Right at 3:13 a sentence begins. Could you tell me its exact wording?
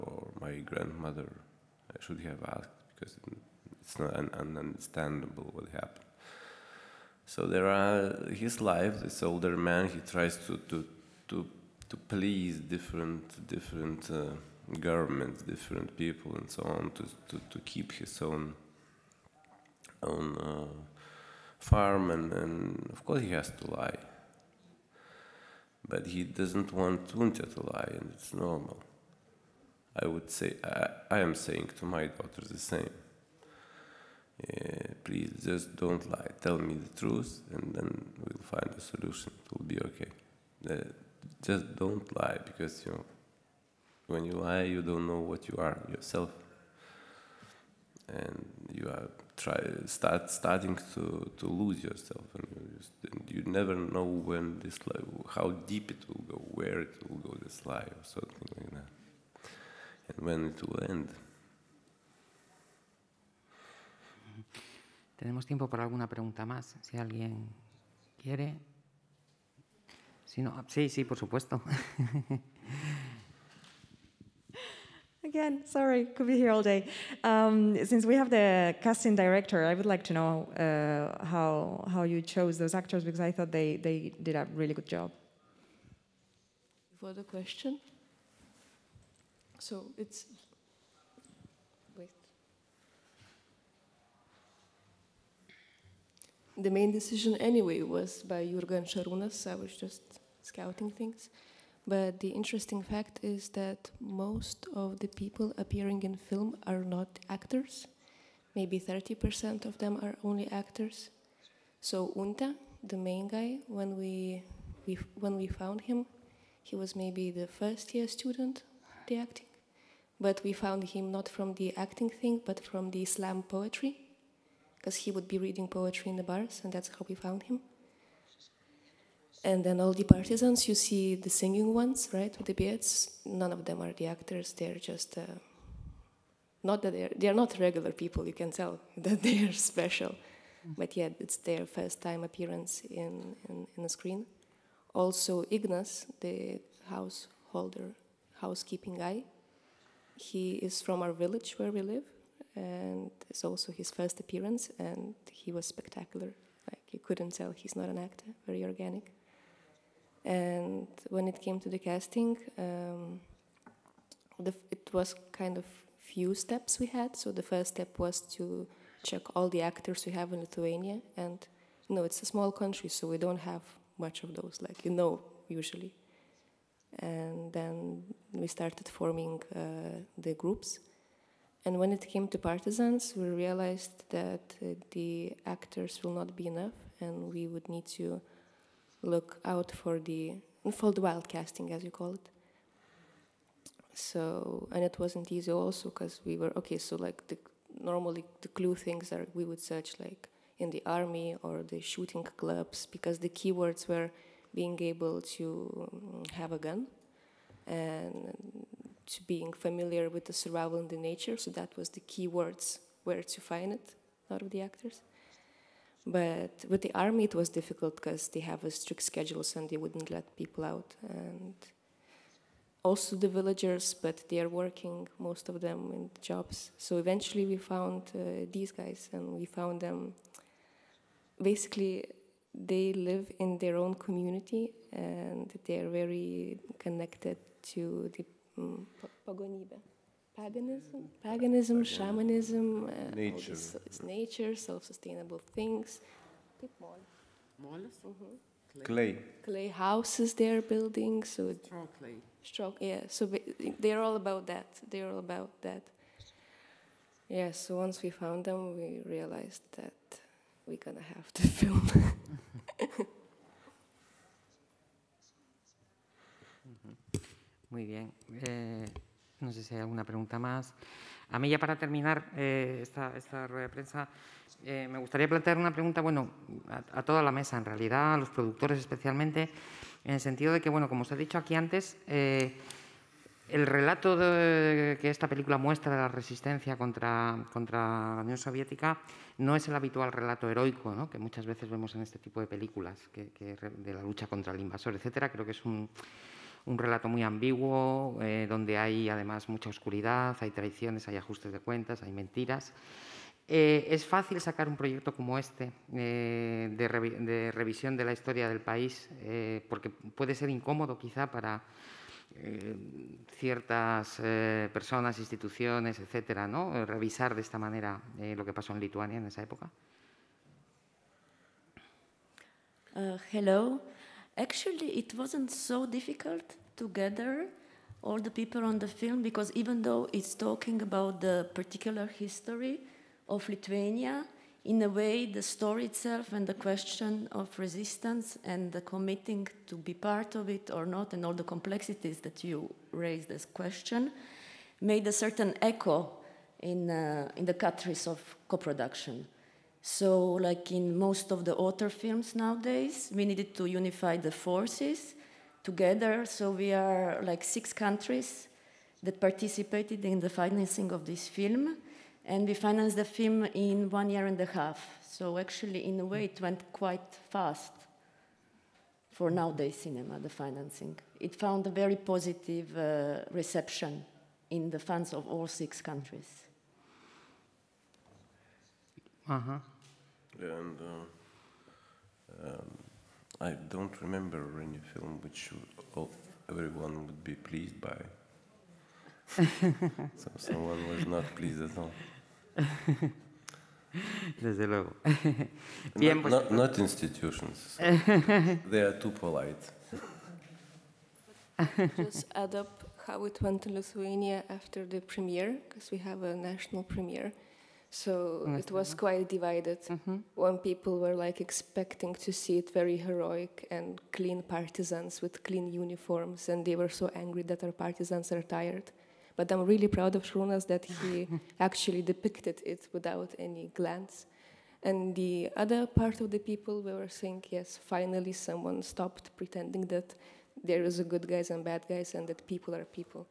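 So, and it wasn't easy also because we were okay.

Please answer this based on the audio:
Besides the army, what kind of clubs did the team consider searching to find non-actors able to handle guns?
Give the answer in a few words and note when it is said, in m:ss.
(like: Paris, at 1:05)
Shooting clubs, at 3:21.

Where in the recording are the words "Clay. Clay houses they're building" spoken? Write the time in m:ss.
4:08.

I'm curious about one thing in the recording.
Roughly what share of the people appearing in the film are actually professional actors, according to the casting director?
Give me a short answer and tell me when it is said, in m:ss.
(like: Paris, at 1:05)
30%, at 1:48.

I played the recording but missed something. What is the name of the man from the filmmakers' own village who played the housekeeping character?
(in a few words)
Ignas.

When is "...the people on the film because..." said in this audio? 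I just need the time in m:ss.
5:28.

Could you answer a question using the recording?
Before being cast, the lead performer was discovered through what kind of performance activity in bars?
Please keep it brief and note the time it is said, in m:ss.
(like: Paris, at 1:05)
Slam poetry, at 2:03.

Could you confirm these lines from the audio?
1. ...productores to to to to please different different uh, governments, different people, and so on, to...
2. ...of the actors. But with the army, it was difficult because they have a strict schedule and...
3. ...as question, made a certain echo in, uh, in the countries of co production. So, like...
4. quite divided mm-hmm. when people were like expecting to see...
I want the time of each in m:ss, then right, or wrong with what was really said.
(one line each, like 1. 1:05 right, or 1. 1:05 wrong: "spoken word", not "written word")
1. 0:09 wrong: "tries", not "productores"
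2. 3:34 right
3. 5:43 right
4. 6:48 right.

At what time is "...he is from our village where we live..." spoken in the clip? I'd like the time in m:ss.
2:30.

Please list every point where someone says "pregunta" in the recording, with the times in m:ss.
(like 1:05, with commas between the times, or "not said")
1:06, 4:30, 4:35.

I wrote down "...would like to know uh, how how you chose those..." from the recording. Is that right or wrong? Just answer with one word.
right.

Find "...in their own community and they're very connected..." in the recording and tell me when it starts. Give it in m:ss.
3:53.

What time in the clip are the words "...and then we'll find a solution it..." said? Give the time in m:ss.
0:37.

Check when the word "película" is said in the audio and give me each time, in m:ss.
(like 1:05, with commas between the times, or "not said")
4:45, 4:52.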